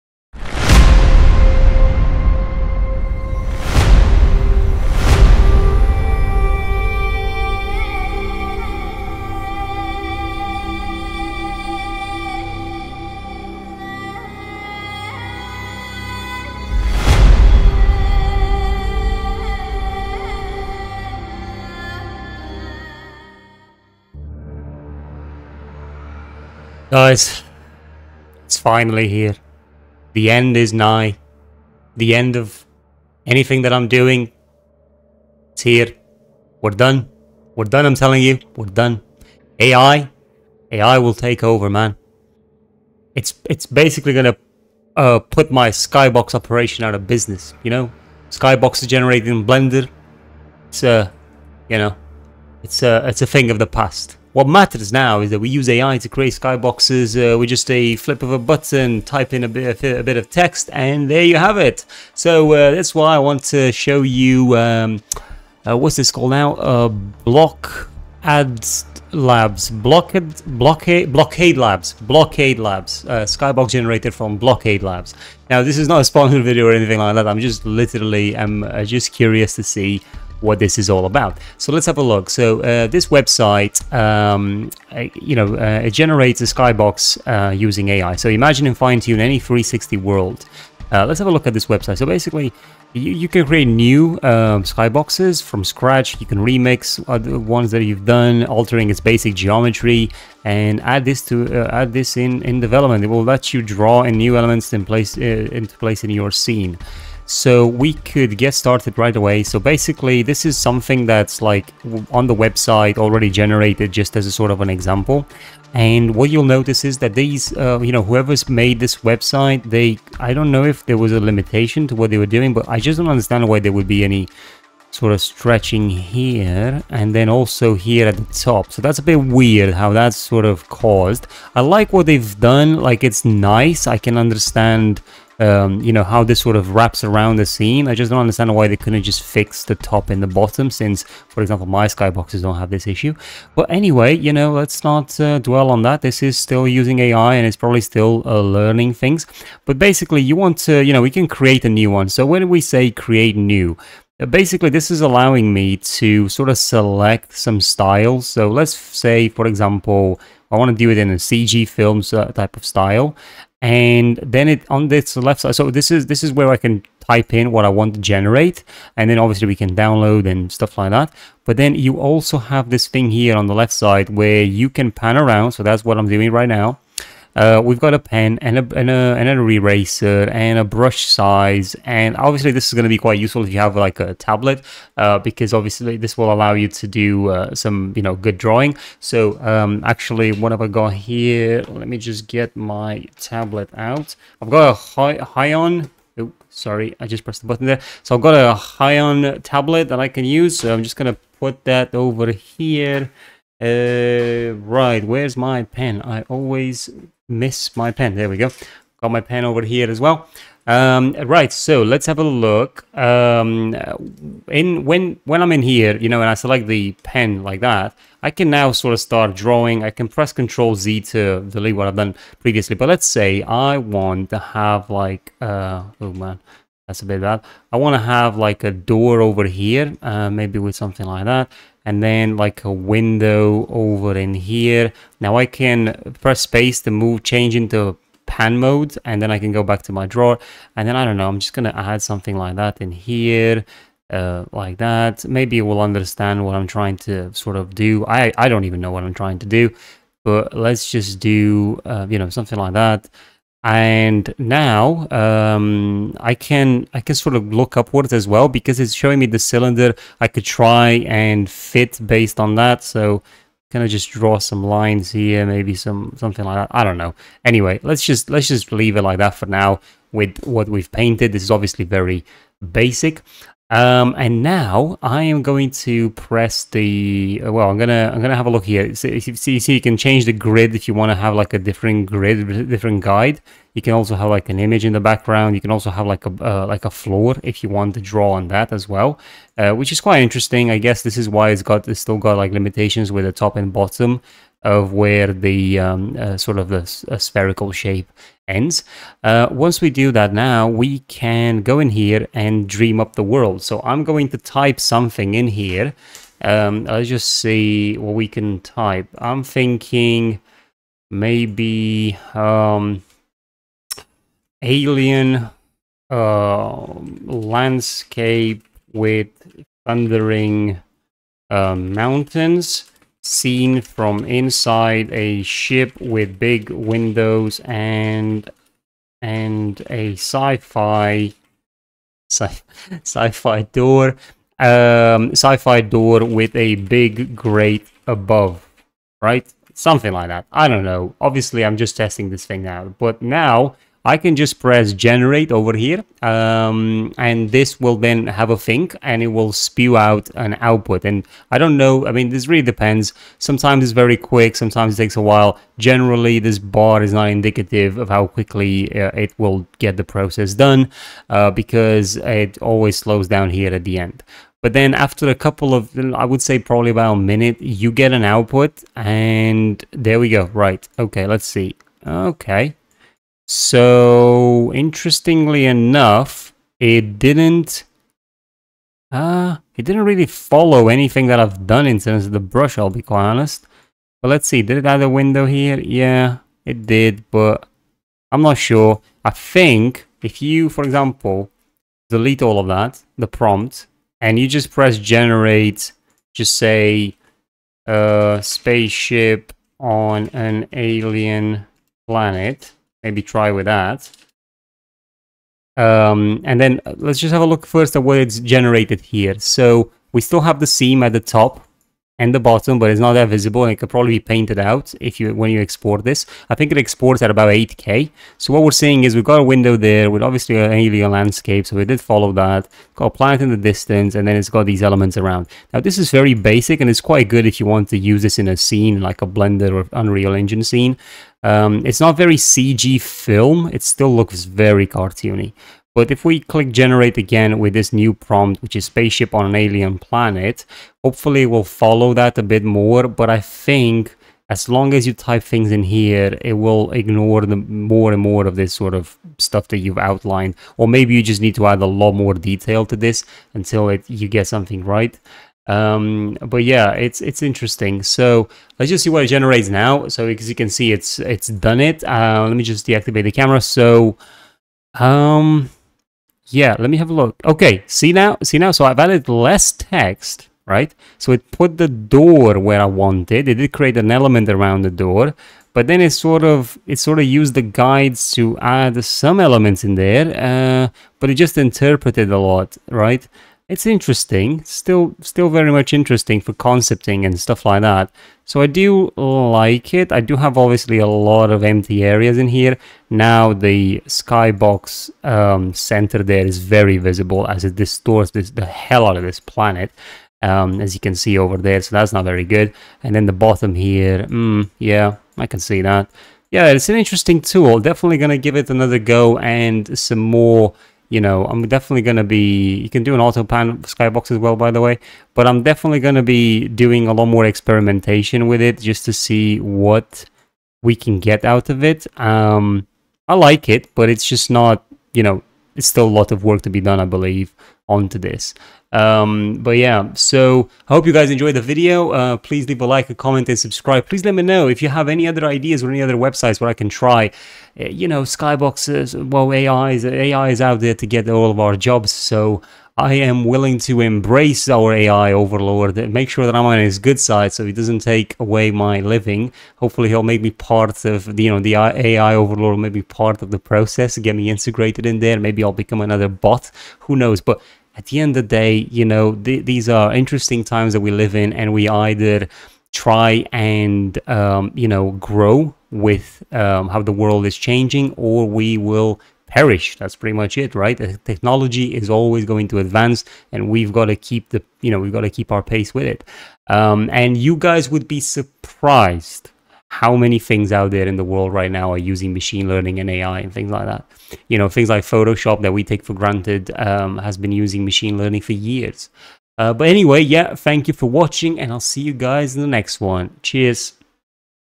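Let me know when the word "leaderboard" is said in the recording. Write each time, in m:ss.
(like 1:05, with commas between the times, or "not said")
not said.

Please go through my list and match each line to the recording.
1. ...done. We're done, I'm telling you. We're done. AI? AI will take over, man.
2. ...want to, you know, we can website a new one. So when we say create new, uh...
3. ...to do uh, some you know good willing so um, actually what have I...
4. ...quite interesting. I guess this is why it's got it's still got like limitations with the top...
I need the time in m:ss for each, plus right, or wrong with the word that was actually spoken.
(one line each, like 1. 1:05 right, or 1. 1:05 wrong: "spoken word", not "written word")
1. 0:36 right
2. 2:30 wrong: "create", not "website"
3. 3:06 wrong: "drawing", not "willing"
4. 4:50 right.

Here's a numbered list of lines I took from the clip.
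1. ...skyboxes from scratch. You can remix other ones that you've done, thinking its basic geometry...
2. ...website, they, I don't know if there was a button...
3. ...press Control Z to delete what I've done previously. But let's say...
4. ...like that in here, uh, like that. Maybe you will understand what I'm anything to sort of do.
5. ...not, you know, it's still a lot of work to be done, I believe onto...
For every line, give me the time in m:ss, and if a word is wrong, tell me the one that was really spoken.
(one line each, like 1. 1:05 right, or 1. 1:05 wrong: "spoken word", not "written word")
1. 1:34 wrong: "altering", not "thinking"
2. 1:58 wrong: "limitation", not "button"
3. 3:40 right
4. 4:02 wrong: "trying", not "anything"
5. 8:44 right.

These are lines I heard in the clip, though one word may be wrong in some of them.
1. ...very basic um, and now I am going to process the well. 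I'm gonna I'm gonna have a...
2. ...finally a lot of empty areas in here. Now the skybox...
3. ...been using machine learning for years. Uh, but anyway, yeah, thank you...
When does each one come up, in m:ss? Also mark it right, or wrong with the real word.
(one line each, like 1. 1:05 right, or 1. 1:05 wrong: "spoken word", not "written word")
1. 4:31 wrong: "press", not "process"
2. 8:10 wrong: "obviously", not "finally"
3. 9:47 right.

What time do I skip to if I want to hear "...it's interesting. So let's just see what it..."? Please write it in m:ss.
7:37.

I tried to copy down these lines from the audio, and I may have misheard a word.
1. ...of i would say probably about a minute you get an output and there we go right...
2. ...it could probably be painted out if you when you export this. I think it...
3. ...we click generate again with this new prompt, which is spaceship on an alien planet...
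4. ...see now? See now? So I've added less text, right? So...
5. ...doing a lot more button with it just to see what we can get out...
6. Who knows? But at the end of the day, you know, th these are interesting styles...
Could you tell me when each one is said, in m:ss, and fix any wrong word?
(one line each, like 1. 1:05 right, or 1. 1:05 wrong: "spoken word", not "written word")
1. 6:05 right
2. 6:53 right
3. 7:16 right
4. 7:47 right
5. 8:36 wrong: "experimentation", not "button"
6. 9:17 wrong: "times", not "styles".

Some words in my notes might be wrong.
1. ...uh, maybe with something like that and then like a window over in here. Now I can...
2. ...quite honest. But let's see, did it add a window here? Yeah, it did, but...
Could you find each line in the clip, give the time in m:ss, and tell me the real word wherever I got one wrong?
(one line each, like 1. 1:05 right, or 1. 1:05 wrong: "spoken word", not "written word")
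1. 3:50 right
2. 6:23 right.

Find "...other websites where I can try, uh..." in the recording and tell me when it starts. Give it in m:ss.
8:56.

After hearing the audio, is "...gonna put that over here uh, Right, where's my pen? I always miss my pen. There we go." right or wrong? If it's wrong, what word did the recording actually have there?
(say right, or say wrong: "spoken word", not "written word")
right.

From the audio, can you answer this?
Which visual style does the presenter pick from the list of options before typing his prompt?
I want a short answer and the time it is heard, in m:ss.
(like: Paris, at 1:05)
CG films, at 2:41.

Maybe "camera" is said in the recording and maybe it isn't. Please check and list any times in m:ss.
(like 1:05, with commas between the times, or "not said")
7:43.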